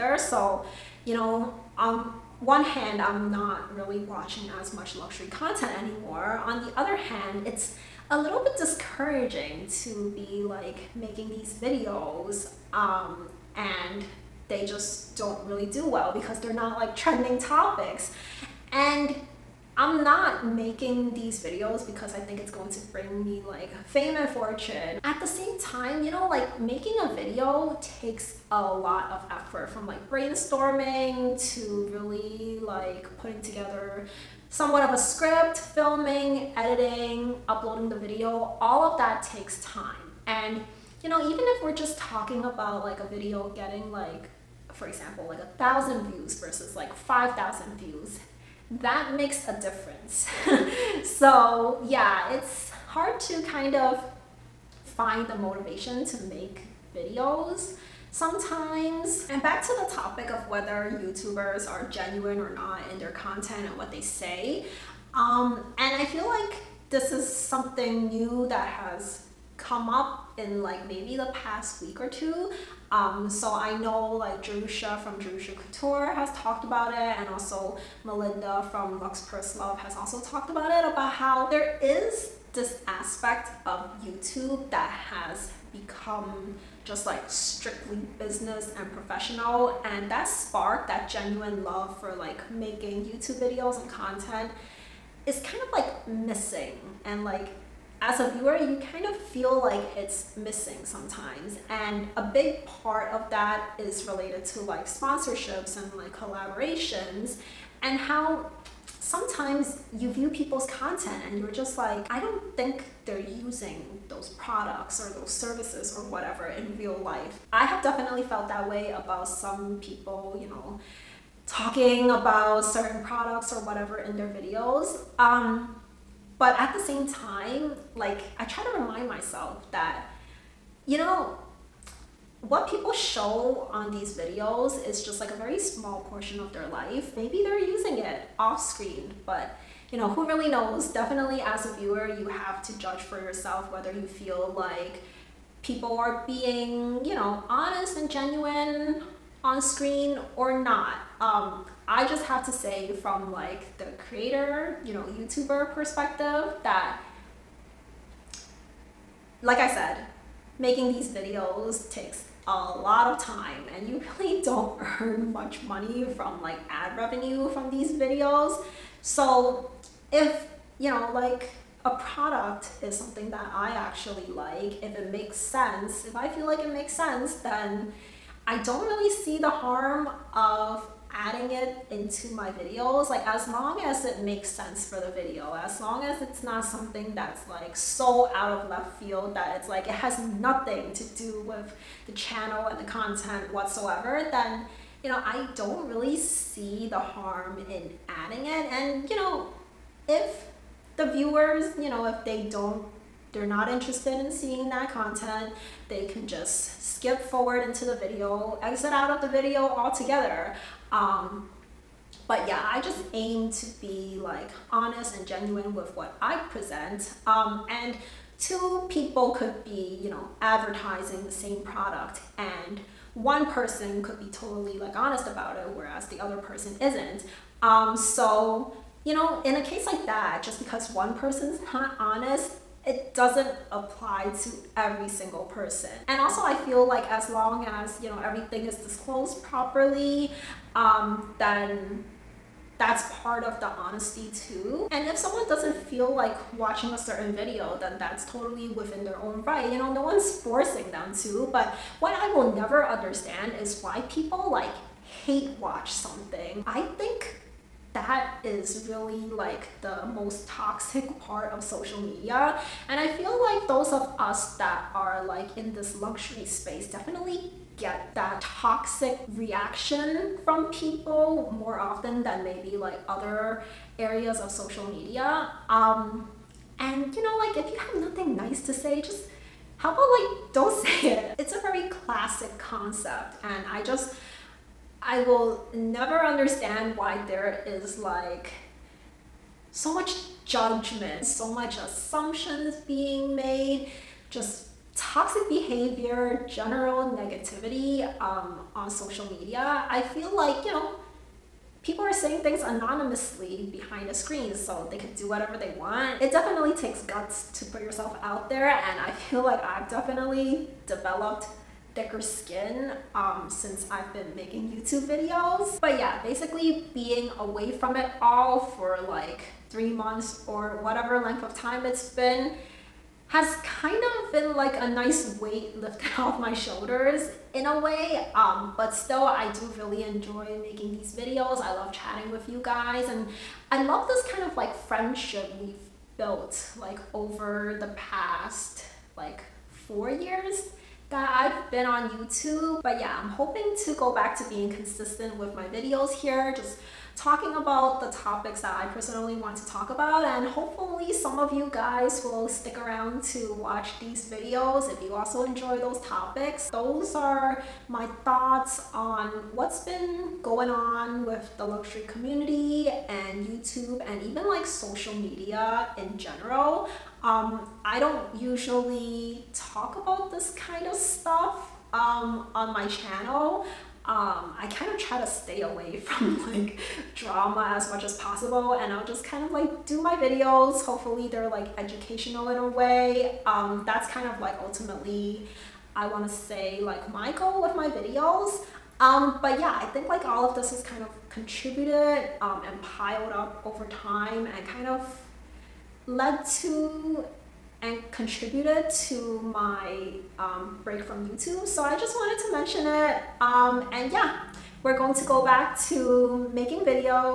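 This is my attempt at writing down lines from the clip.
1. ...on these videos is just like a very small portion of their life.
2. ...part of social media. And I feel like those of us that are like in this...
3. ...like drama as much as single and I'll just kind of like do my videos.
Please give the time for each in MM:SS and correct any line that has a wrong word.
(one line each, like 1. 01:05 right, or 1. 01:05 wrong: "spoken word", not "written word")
1. 02:13 right
2. 04:21 right
3. 06:16 wrong: "possible", not "single".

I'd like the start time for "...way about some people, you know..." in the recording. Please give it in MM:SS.
01:58.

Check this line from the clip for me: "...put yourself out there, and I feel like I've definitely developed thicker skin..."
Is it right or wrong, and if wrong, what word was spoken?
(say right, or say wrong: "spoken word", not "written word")
right.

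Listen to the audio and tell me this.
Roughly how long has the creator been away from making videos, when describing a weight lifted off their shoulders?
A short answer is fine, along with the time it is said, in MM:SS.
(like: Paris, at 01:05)
3 months, at 05:19.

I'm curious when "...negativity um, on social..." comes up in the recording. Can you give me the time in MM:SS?
04:57.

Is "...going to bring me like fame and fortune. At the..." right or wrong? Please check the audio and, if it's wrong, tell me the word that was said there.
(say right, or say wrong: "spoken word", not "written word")
right.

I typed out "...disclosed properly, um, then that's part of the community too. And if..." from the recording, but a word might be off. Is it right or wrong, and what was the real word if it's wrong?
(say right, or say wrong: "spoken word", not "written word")
wrong: "honesty", not "community".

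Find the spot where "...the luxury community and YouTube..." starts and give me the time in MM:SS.
06:01.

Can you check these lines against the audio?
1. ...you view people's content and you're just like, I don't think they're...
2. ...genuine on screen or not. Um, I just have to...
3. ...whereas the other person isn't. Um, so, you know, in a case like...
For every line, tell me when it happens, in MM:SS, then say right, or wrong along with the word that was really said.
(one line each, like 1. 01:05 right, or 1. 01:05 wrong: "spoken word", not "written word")
1. 01:49 right
2. 02:28 right
3. 03:45 right.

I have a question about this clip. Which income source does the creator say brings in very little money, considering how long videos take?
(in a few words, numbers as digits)
Ad revenue.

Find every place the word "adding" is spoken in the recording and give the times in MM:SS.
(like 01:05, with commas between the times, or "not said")
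03:01, 03:18.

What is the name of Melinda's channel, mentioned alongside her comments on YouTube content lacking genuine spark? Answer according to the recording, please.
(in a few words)
Lux Purse Love.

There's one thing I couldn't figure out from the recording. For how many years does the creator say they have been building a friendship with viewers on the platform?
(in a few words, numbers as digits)
4 years.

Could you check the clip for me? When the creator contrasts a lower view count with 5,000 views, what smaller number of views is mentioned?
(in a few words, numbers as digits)
1,000.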